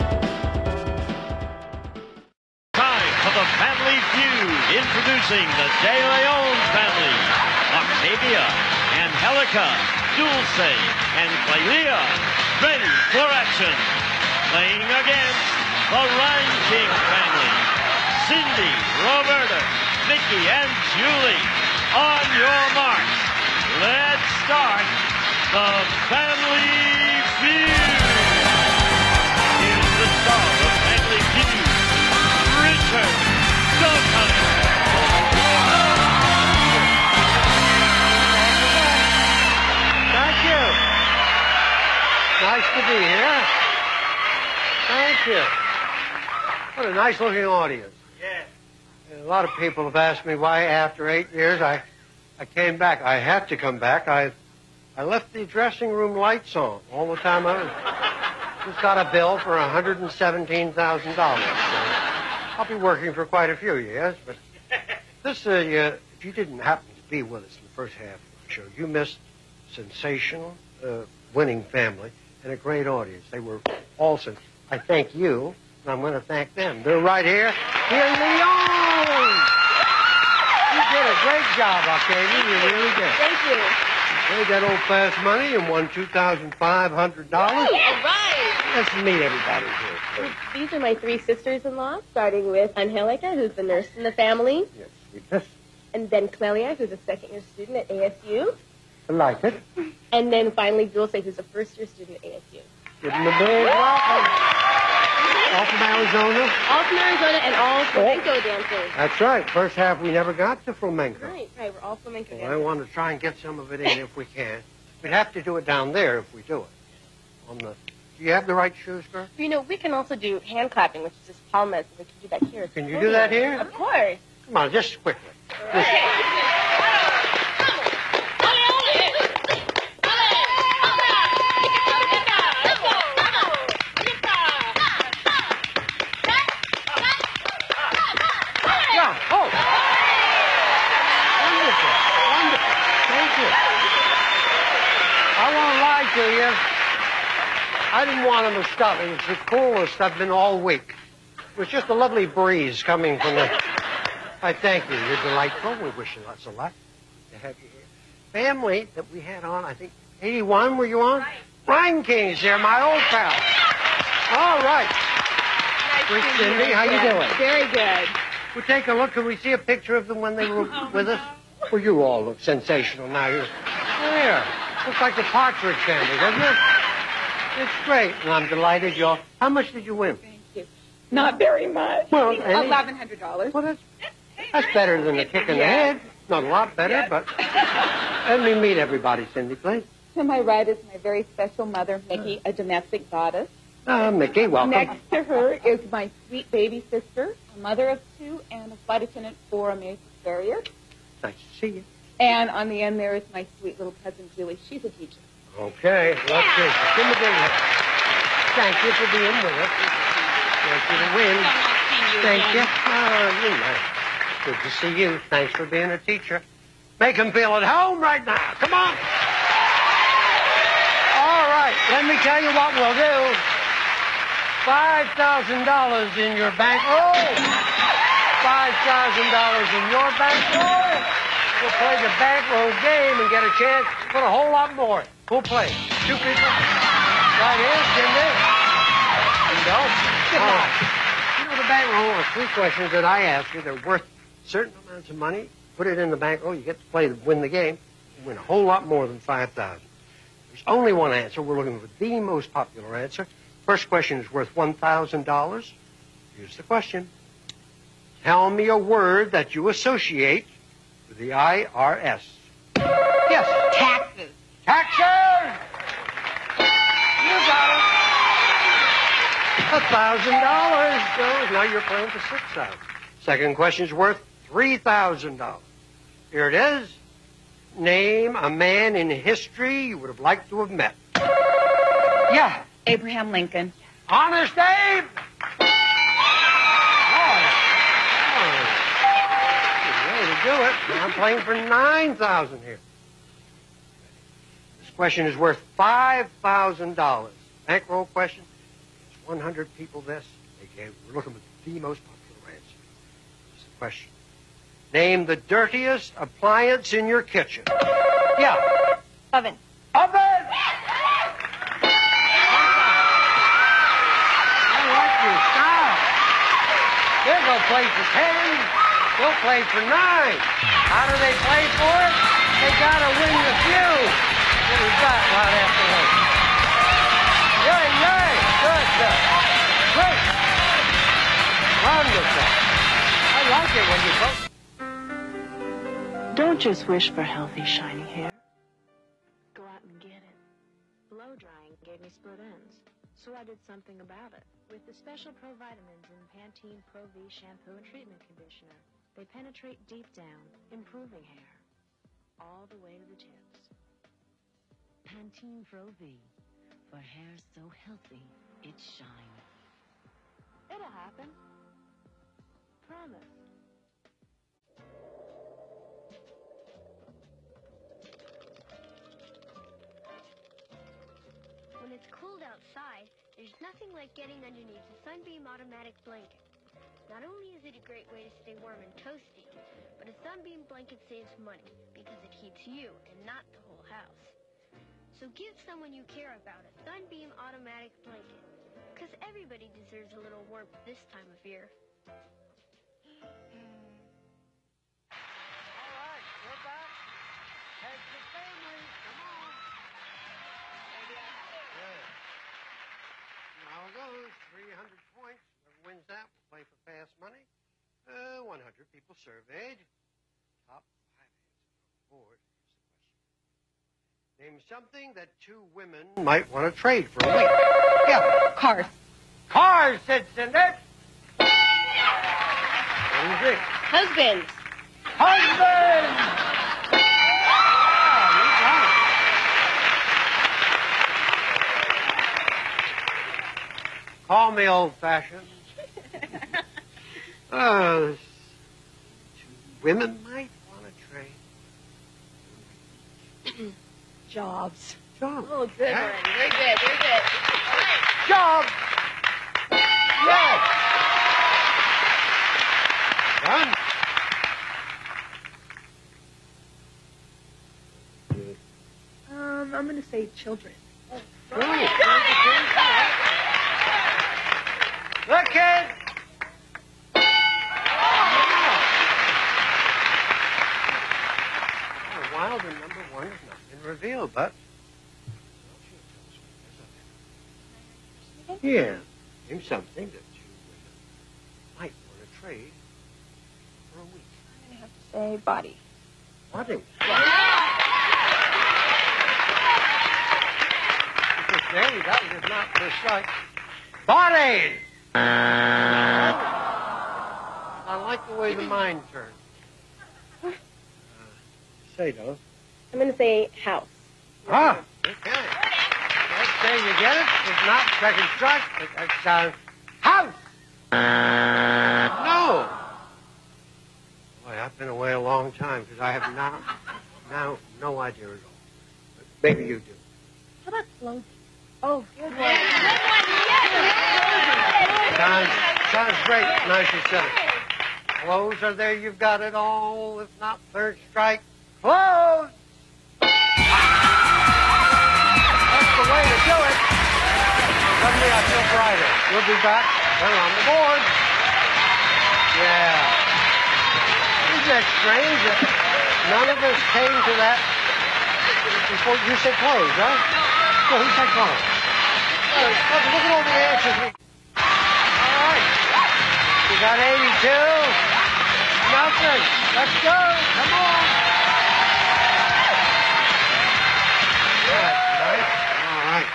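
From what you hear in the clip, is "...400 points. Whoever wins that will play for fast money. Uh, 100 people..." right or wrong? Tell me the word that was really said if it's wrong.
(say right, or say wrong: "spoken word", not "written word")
wrong: "300", not "400".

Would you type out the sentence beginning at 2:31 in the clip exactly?
It was just a lovely breeze coming from the.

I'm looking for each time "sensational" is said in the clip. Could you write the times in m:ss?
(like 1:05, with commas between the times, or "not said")
1:09, 2:52.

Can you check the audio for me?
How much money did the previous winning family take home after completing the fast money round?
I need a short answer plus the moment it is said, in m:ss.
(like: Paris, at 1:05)
$2,500, at 1:25.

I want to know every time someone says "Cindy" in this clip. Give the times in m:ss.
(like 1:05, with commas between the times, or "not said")
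2:46, 3:09, 7:00.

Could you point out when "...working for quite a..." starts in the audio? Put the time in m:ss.
1:02.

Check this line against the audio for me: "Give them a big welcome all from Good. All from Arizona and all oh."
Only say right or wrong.
wrong.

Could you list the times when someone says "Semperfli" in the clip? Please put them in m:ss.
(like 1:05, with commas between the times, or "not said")
not said.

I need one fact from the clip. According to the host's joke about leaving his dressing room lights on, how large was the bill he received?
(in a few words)
$117,000.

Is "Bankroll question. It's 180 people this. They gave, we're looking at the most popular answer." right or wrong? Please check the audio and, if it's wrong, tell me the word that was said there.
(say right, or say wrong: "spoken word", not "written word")
wrong: "100", not "180".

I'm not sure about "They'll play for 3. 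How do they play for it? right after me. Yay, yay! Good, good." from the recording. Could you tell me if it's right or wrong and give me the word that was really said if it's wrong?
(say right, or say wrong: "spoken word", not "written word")
wrong: "9", not "3".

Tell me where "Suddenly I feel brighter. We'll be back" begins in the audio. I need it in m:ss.
8:57.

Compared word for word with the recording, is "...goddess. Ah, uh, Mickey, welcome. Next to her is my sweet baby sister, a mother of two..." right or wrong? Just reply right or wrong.
right.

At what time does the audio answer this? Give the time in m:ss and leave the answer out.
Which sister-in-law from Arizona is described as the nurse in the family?
1:32.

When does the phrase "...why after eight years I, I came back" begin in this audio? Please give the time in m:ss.
0:50.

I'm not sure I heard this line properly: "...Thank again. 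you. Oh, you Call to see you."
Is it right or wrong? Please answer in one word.
wrong.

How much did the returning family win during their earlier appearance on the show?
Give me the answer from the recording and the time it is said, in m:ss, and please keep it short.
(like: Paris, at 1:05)
$1,100, at 3:02.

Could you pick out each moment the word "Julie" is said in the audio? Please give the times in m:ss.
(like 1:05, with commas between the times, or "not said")
0:20, 3:24.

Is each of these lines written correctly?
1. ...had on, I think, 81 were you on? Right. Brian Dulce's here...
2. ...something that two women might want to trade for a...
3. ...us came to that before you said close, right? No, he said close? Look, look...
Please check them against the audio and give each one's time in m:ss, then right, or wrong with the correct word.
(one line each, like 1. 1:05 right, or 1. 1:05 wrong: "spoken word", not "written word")
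1. 2:39 wrong: "King", not "Dulce"
2. 6:54 right
3. 9:06 right.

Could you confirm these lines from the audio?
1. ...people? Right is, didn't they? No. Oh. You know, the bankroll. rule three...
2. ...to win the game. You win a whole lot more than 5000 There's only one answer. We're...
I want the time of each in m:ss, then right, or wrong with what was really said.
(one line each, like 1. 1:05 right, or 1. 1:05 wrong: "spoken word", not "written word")
1. 3:56 right
2. 4:07 right.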